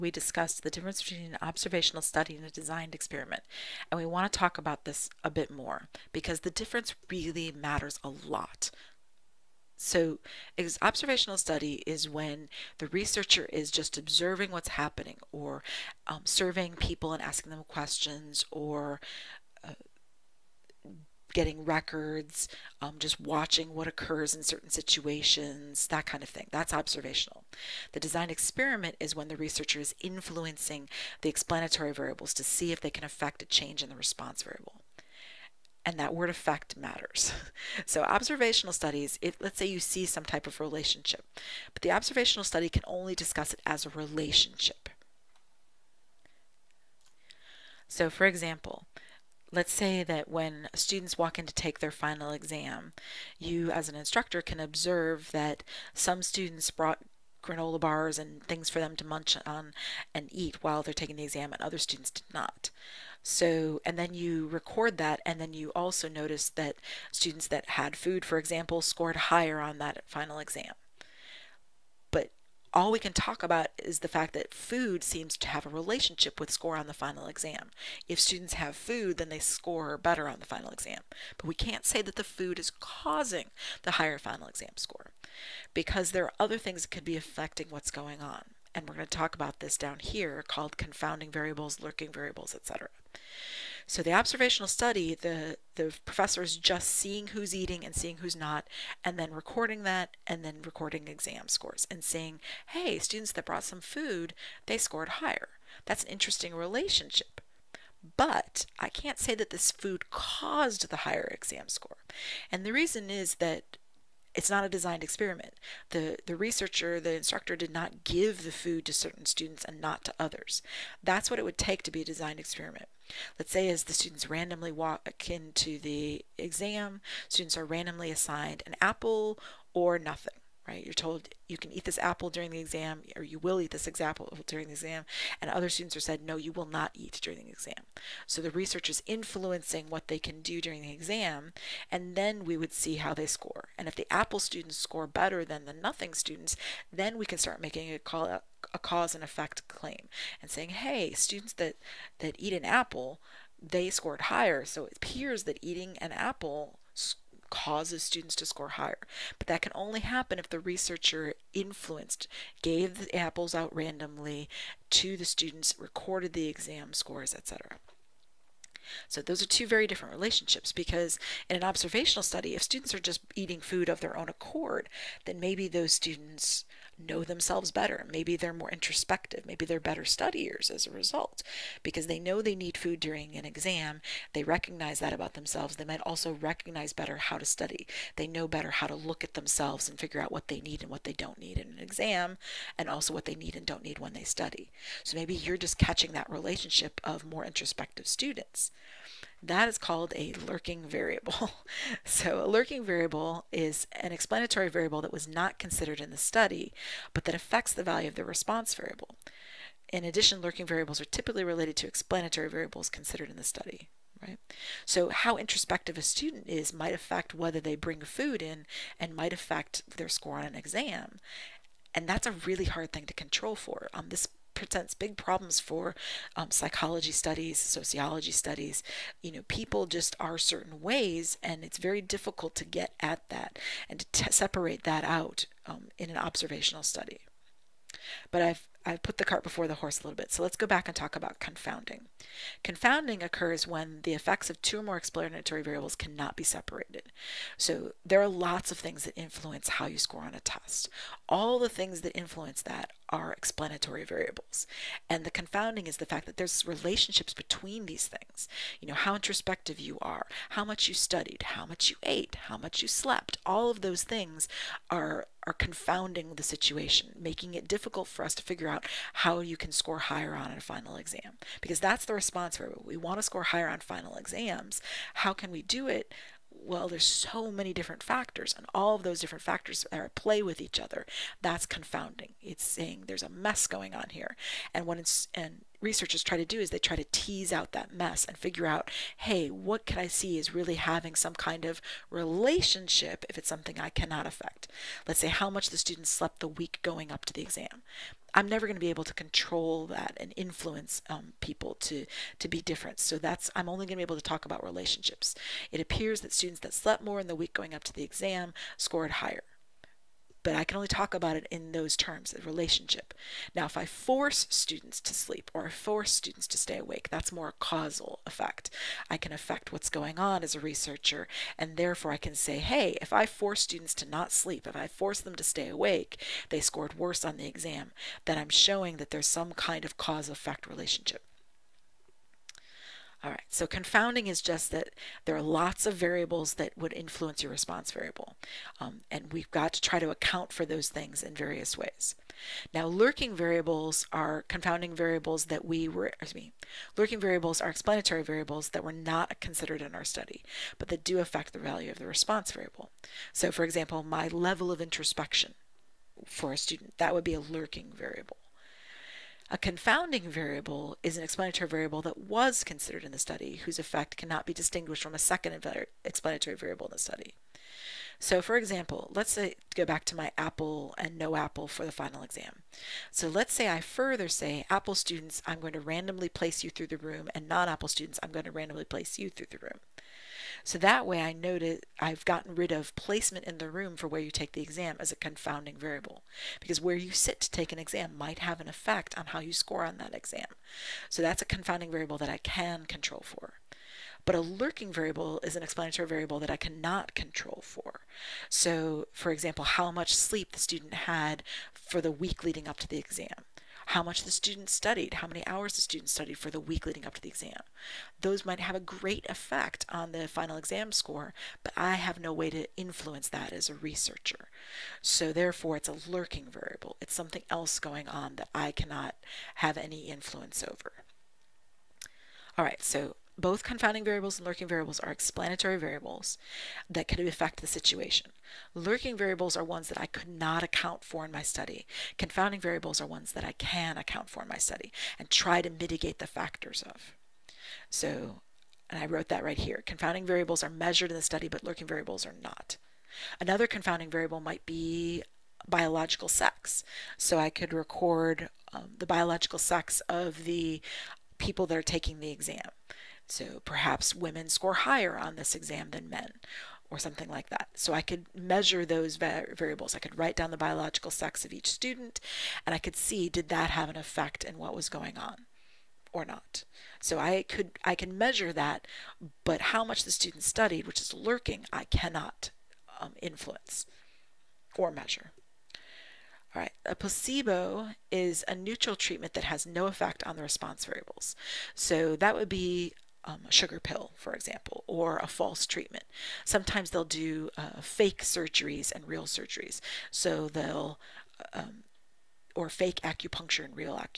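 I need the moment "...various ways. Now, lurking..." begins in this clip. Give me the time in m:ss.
5:41.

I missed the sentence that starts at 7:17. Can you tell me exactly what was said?
So, and I wrote that right here.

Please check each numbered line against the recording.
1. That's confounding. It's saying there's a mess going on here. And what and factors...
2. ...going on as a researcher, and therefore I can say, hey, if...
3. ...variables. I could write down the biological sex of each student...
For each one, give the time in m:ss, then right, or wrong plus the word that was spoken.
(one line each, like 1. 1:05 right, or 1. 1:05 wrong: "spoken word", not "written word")
1. 4:41 wrong: "researchers", not "factors"
2. 5:19 right
3. 7:39 right.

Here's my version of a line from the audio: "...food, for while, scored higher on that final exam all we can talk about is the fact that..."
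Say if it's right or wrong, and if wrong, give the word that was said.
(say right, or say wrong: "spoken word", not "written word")
wrong: "example", not "while".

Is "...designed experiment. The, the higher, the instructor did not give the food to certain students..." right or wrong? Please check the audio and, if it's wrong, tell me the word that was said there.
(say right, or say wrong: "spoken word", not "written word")
wrong: "researcher", not "higher".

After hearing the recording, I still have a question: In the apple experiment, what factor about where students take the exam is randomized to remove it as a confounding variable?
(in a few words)
placement in the room.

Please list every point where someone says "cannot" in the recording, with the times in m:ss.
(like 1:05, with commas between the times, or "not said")
4:05, 4:53, 6:04, 6:36, 6:58, 7:51.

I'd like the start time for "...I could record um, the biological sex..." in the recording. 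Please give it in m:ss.
7:27.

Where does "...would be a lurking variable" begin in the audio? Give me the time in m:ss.
5:57.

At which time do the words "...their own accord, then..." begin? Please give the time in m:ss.
2:53.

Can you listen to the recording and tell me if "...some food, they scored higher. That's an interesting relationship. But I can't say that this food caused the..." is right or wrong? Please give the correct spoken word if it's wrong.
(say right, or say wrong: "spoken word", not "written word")
right.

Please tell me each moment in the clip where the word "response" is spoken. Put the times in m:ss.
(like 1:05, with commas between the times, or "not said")
0:33, 3:28, 4:32, 5:37, 5:52, 8:00.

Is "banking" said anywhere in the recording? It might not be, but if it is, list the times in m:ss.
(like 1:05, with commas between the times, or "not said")
not said.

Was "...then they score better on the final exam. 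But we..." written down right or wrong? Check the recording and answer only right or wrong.
right.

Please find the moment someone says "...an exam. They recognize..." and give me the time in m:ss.
3:03.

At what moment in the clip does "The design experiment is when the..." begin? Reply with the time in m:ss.
0:27.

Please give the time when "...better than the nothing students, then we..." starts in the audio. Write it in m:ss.
2:25.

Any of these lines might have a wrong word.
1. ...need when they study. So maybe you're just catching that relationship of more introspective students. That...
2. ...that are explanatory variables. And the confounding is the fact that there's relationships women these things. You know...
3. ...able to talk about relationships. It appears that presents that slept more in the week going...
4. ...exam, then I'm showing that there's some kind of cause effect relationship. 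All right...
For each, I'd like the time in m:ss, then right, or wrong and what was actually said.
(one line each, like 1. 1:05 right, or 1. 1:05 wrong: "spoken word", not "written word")
1. 3:13 right
2. 4:12 wrong: "between", not "women"
3. 5:04 wrong: "students", not "presents"
4. 5:27 right.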